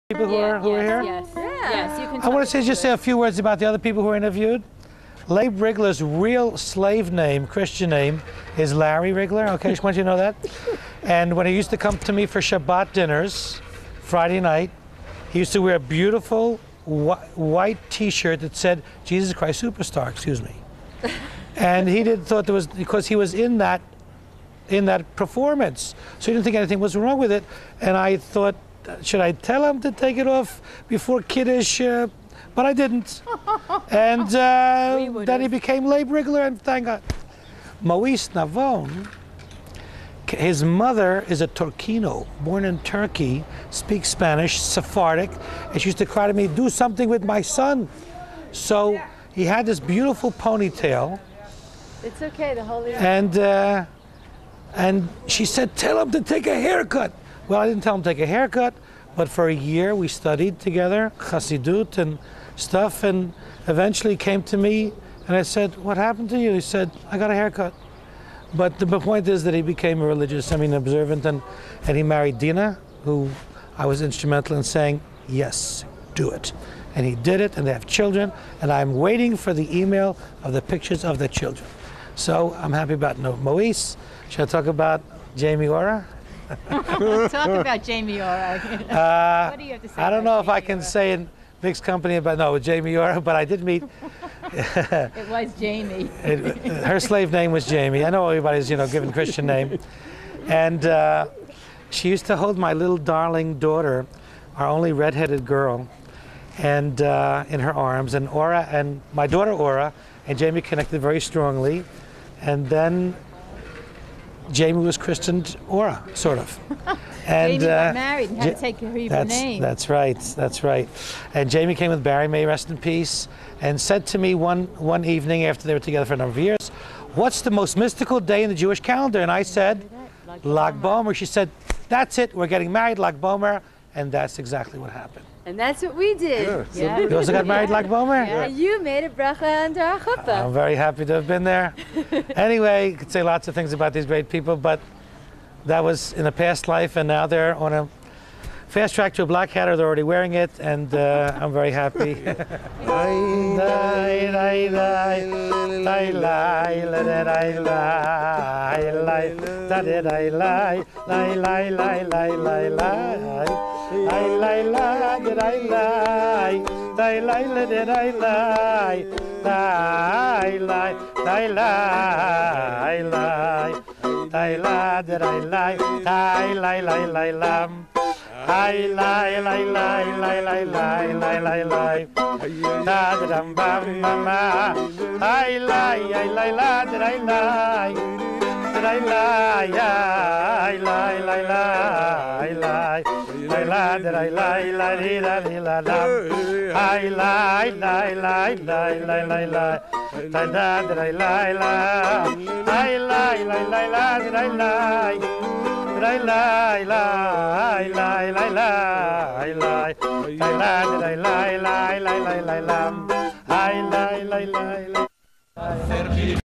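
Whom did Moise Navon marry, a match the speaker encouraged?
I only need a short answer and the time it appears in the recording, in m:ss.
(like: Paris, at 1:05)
Dina, at 1:12.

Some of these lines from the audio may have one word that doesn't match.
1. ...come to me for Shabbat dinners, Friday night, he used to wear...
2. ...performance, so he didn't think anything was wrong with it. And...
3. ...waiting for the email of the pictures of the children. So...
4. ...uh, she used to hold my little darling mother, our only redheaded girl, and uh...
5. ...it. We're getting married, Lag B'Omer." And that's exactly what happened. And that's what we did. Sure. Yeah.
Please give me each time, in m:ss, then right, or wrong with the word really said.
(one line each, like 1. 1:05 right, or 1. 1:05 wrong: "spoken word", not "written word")
1. 0:11 right
2. 0:25 right
3. 1:18 right
4. 1:40 wrong: "daughter", not "mother"
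5. 2:12 right.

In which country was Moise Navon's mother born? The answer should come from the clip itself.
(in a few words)
Turkey.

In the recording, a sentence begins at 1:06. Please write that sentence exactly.
He said, I got a haircut.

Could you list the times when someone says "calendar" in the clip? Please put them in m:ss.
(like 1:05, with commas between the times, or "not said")
2:08.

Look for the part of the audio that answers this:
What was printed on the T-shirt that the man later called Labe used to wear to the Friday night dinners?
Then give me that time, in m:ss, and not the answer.
0:19.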